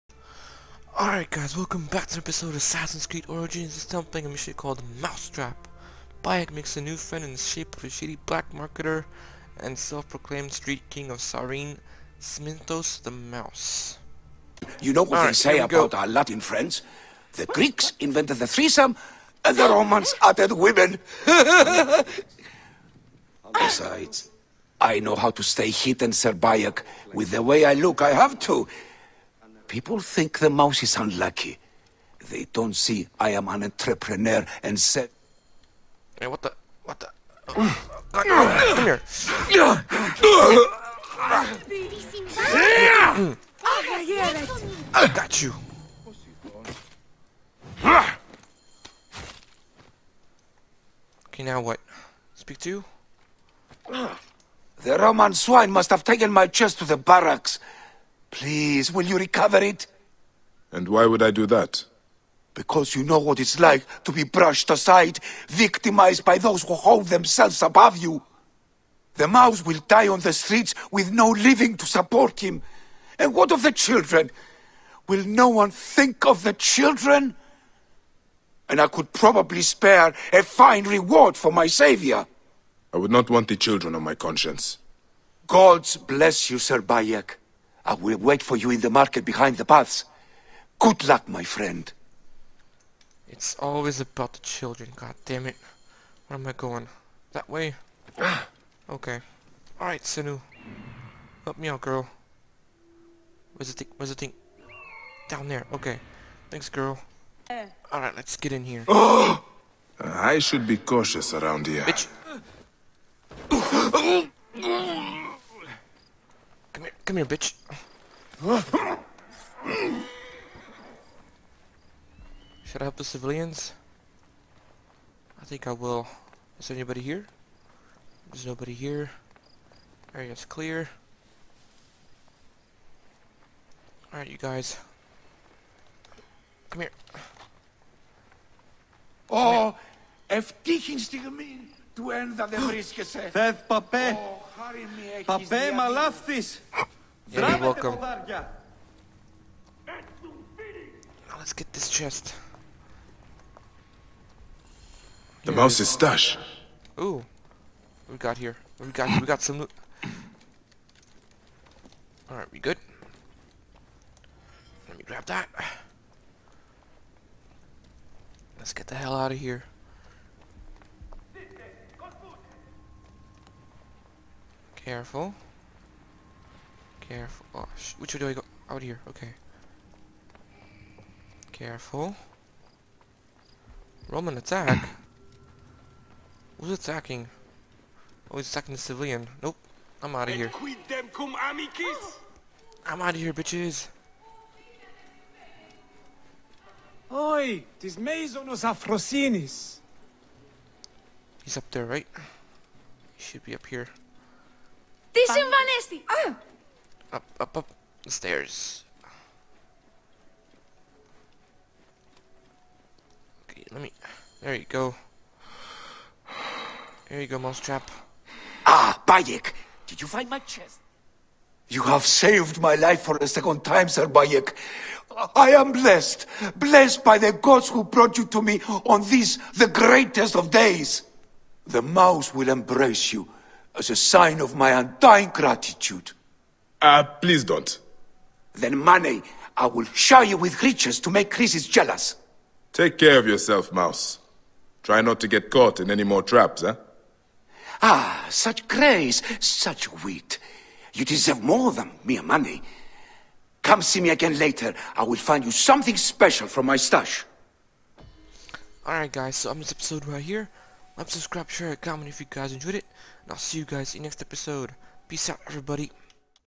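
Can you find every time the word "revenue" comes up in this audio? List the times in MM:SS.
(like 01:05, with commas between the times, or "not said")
not said.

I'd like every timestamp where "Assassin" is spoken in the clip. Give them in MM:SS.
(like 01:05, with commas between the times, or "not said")
00:02.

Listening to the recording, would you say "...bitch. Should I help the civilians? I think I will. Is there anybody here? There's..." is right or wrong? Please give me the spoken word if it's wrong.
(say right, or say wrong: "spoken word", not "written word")
right.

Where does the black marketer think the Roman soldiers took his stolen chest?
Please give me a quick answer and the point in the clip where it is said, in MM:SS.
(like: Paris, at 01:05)
the barracks, at 00:56.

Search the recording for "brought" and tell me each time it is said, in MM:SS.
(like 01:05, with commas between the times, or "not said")
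03:47.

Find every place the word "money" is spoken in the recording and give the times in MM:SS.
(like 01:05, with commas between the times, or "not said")
03:58, 04:12.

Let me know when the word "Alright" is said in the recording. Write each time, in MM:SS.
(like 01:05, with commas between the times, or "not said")
00:01, 01:39, 01:47, 02:14, 02:42, 04:18.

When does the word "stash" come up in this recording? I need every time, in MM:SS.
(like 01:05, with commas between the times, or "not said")
02:35, 04:16.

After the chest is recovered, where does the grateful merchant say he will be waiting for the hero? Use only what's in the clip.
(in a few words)
the market behind the paths.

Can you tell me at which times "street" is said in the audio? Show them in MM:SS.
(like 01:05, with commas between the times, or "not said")
00:10, 01:10.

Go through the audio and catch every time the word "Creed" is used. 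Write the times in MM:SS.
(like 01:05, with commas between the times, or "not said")
00:03.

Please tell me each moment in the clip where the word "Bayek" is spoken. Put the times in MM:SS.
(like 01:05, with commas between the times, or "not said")
00:06, 00:26, 01:26, 03:39, 03:44.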